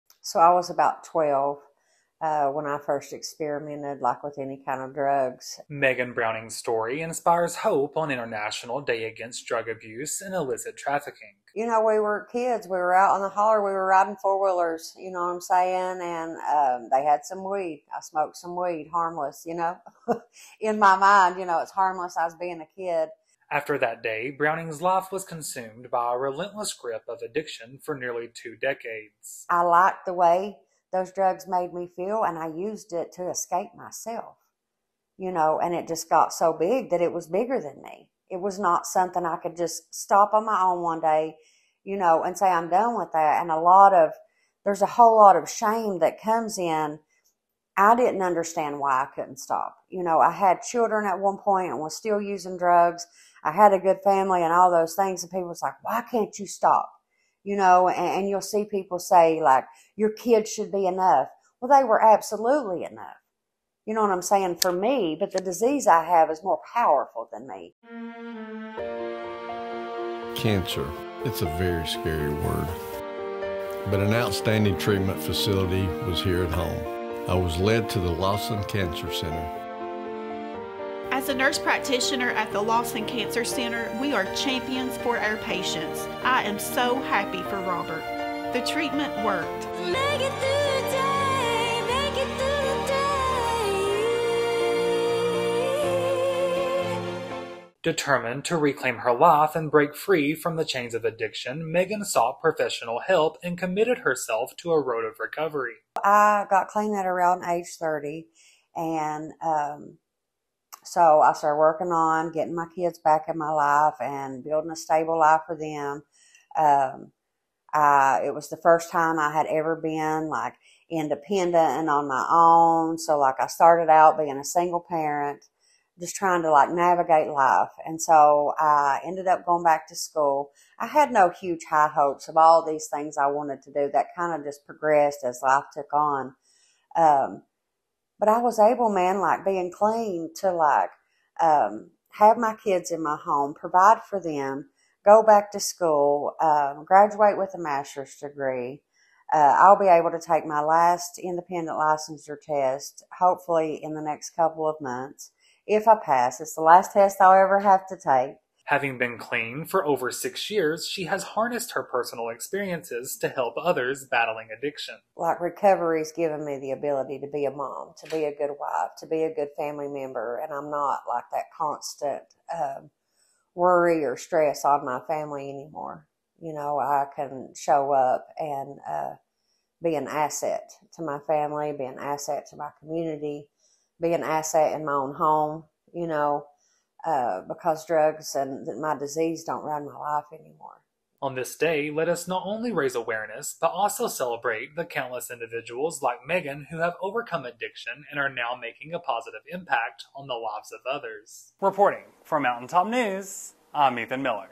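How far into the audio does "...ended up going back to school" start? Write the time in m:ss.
2:09.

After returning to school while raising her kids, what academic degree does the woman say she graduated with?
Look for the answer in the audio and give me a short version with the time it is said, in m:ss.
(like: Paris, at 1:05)
master's degree, at 2:27.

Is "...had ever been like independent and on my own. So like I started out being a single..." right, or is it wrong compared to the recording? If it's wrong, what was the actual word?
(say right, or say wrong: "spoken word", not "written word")
right.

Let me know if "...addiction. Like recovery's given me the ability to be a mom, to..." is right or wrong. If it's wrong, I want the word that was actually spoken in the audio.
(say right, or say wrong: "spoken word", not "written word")
right.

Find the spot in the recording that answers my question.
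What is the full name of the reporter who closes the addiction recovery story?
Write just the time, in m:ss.
3:23.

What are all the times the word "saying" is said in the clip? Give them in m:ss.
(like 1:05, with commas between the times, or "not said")
0:15, 1:04.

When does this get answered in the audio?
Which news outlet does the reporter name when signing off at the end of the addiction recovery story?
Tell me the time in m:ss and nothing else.
3:22.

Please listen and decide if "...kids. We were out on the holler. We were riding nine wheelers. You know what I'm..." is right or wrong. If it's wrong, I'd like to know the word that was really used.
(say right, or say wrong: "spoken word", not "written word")
wrong: "four", not "nine".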